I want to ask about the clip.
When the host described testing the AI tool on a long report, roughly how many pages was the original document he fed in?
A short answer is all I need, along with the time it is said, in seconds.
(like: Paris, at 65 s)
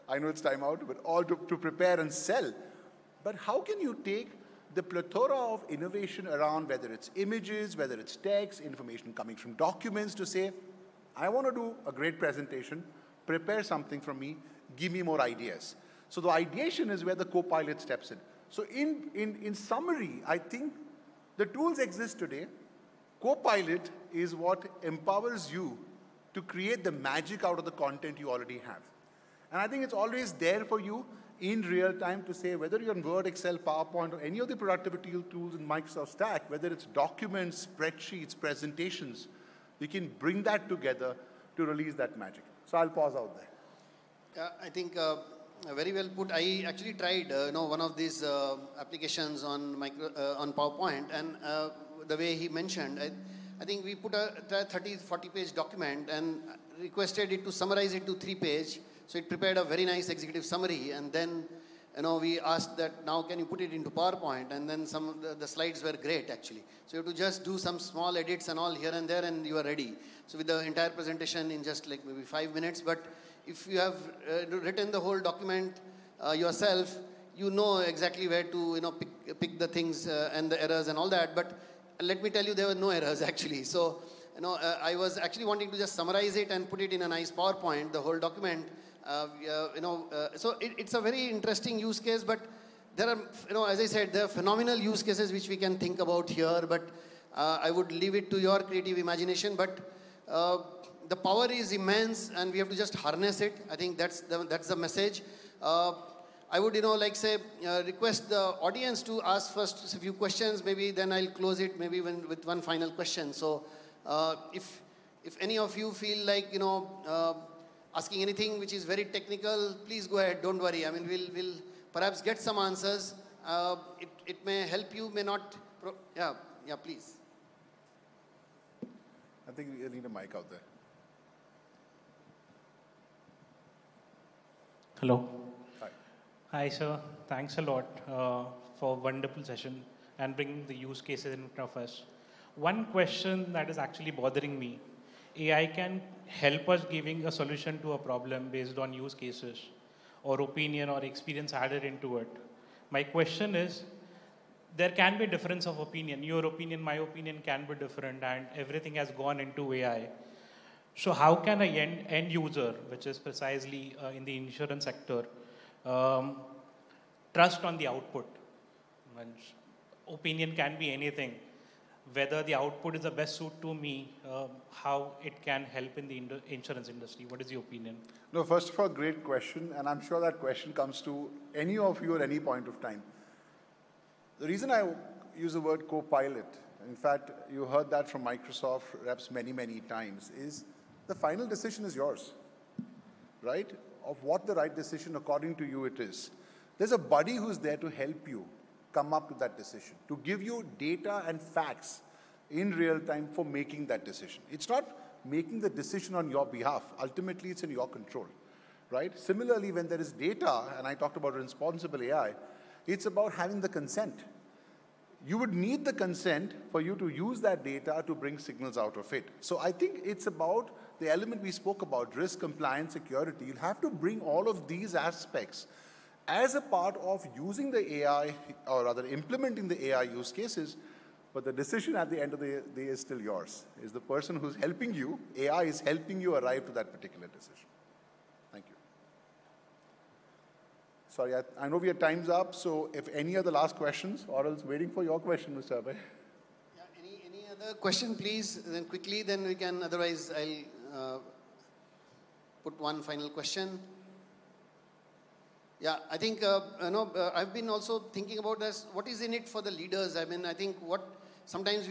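30-40 pages, at 54 s.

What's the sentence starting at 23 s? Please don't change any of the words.
Co-pilot is what empowers you to create the magic out of the content you already have.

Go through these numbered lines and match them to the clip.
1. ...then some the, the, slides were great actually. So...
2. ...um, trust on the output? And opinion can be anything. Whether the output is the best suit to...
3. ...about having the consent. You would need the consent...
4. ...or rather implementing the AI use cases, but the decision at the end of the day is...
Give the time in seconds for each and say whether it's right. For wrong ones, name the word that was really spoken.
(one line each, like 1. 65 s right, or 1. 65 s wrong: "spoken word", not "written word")
1. 64 s right
2. 165 s right
3. 213 s right
4. 228 s right.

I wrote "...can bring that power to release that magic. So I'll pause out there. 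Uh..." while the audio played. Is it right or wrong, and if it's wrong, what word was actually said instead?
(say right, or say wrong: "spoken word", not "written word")
wrong: "together", not "power".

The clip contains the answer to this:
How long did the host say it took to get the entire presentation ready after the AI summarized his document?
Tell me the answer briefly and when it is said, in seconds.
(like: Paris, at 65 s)
5 minutes, at 72 s.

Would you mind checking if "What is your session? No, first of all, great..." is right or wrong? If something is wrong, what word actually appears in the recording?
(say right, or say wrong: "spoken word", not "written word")
wrong: "opinion", not "session".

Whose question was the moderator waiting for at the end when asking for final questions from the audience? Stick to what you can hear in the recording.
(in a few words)
Mr. Abhay.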